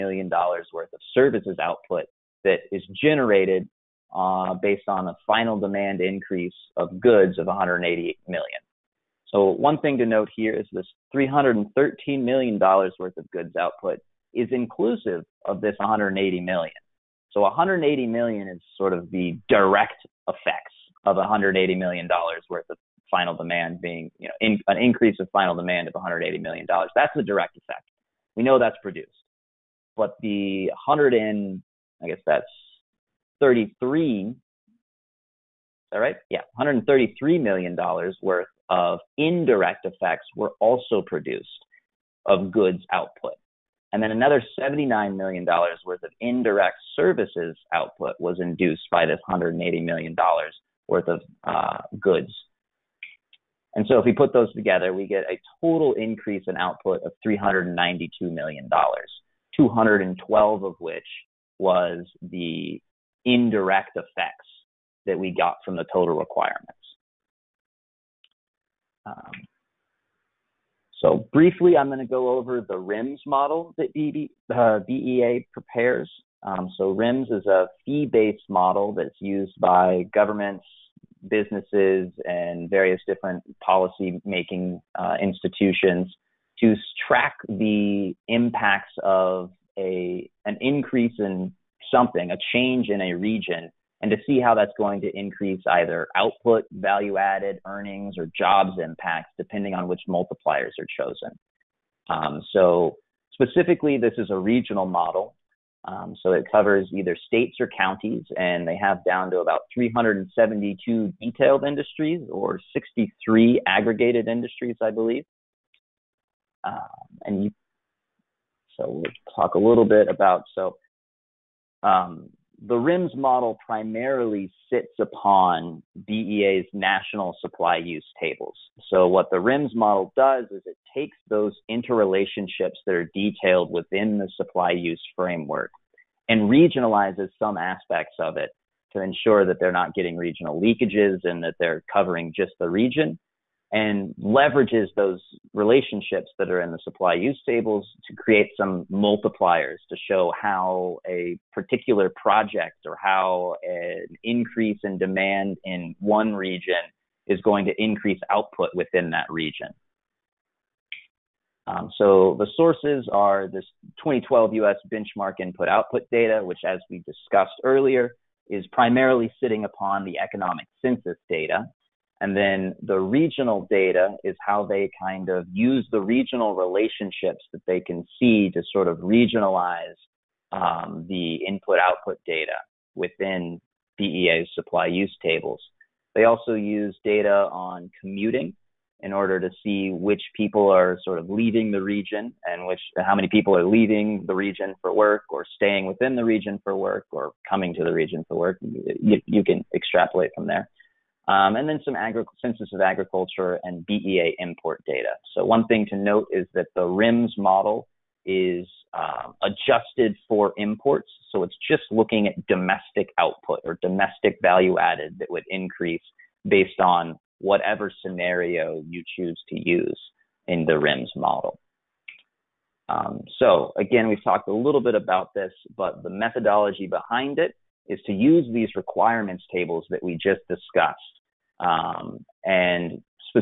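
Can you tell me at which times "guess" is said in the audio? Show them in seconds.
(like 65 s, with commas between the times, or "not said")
32 s.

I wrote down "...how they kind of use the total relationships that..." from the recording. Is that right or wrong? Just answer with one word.
wrong.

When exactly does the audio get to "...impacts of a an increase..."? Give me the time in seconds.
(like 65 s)
88 s.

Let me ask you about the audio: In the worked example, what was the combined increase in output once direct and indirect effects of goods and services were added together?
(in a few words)
$392 million.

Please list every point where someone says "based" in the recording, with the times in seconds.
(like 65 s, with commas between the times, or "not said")
4 s, 77 s, 216 s.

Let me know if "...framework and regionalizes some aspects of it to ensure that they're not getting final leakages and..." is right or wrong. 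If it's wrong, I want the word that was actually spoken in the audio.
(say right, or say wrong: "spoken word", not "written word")
wrong: "regional", not "final".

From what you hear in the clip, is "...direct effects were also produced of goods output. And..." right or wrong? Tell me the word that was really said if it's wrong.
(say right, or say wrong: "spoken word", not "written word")
wrong: "indirect", not "direct".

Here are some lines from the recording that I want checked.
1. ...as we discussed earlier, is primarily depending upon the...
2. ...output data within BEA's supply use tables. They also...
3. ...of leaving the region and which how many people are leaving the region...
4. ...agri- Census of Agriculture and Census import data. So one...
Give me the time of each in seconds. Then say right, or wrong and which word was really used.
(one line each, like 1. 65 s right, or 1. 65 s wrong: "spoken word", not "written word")
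1. 166 s wrong: "sitting", not "depending"
2. 181 s right
3. 191 s right
4. 201 s wrong: "BEA", not "Census".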